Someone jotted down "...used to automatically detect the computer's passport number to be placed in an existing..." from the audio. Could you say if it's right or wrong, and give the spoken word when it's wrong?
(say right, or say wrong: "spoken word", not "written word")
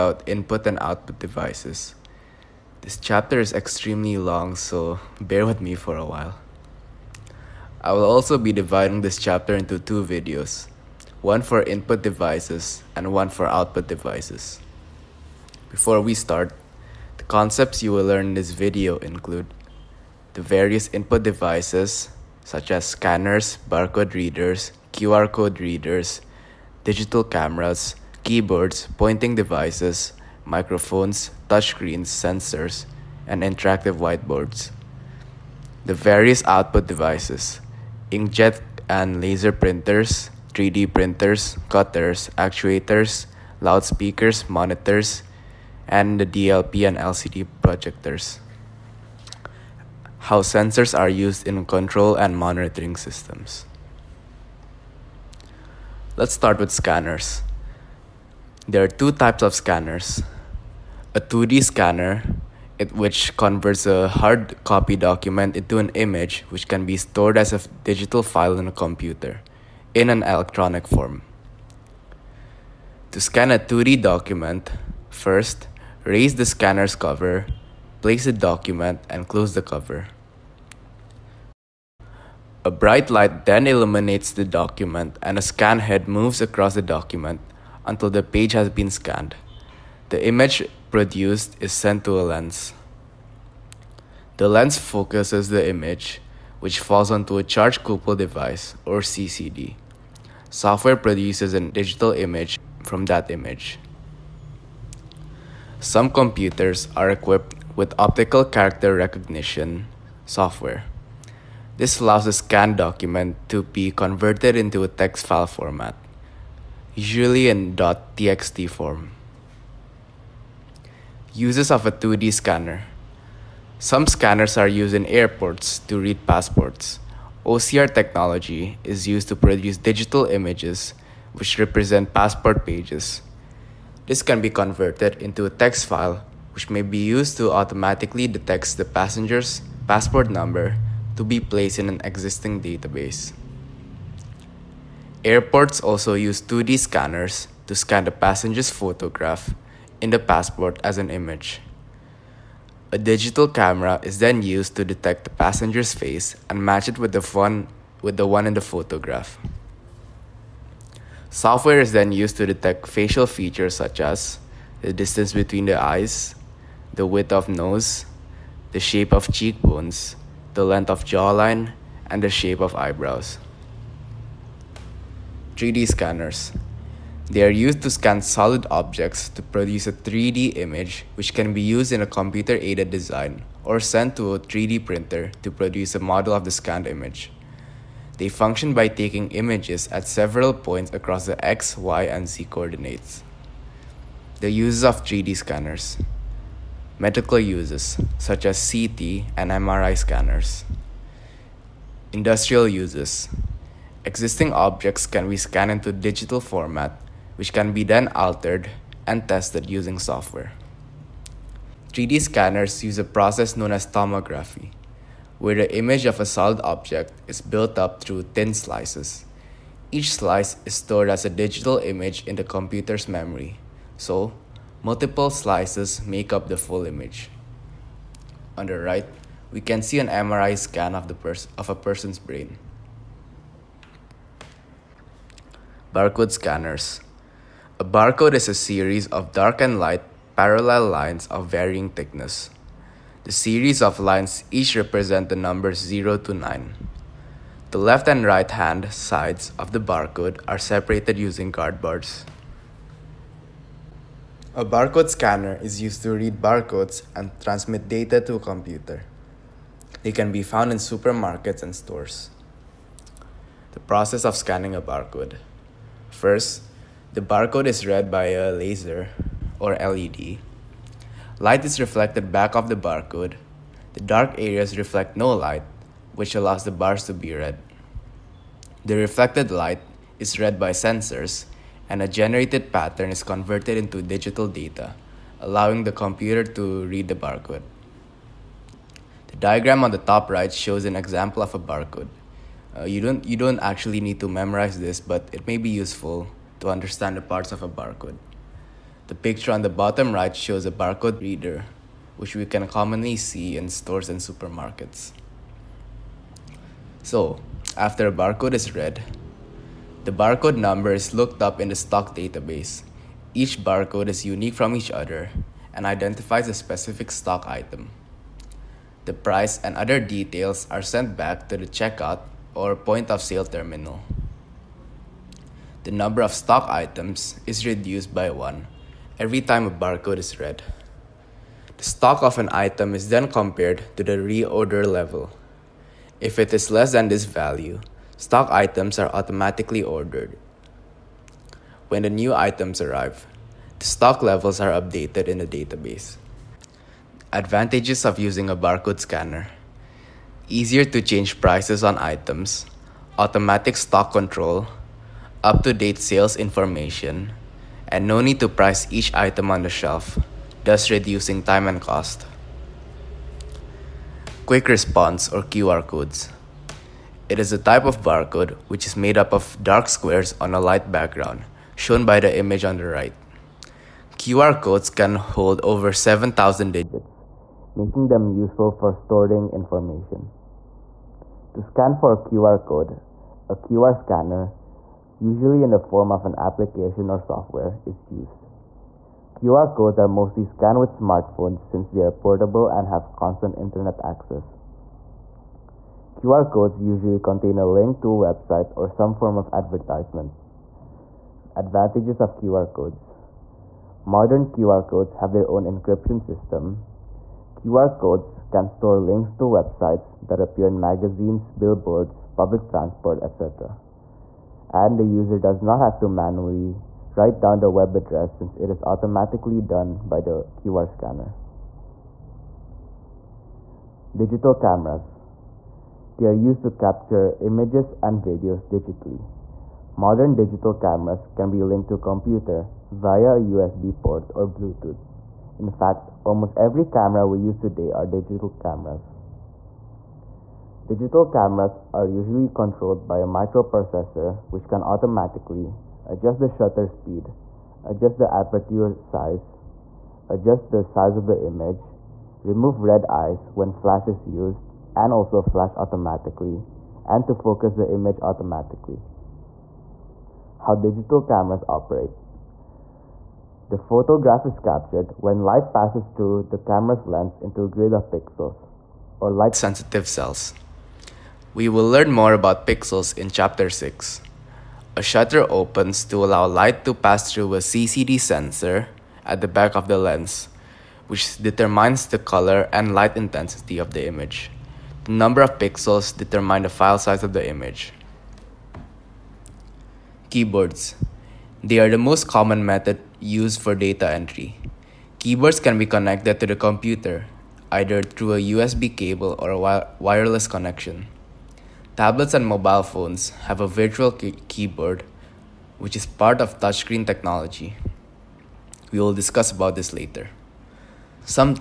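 wrong: "passenger", not "computer".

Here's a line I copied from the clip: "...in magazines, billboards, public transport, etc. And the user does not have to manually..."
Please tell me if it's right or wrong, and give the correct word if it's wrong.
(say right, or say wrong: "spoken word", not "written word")
right.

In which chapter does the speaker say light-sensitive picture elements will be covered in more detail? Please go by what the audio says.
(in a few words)
Chapter 6.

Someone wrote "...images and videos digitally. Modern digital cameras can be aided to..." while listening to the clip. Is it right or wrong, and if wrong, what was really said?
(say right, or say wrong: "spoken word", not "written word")
wrong: "linked", not "aided".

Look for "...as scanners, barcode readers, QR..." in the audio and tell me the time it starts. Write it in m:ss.
0:22.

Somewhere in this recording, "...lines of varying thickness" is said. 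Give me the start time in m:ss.
4:00.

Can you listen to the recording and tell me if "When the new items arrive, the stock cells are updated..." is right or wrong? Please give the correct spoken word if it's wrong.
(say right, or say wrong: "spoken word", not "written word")
wrong: "levels", not "cells".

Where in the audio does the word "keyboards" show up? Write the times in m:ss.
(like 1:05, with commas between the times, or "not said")
0:28, 8:10, 8:15, 8:24.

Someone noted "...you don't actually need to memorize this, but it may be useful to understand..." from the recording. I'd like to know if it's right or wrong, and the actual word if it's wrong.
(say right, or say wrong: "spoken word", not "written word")
right.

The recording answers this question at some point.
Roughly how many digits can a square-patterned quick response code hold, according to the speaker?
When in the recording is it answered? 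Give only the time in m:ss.
6:15.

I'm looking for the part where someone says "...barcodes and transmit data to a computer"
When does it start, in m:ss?
4:16.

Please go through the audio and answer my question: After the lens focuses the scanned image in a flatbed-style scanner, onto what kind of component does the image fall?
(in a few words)
charge couple device.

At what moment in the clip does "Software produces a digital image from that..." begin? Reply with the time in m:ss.
1:40.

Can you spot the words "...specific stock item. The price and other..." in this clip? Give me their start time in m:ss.
5:16.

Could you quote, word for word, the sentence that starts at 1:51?
This allows the scanned document to be converted into a text file format, usually in .txt form.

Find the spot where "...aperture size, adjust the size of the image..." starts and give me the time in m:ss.
7:28.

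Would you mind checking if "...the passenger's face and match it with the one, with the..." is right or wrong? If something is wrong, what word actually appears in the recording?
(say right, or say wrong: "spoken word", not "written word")
right.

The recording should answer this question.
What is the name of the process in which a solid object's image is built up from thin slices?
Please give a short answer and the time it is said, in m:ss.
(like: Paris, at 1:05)
tomography, at 3:33.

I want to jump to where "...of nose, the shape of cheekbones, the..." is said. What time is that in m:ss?
2:47.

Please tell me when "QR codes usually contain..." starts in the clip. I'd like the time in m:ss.
6:36.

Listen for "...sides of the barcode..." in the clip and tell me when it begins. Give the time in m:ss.
4:08.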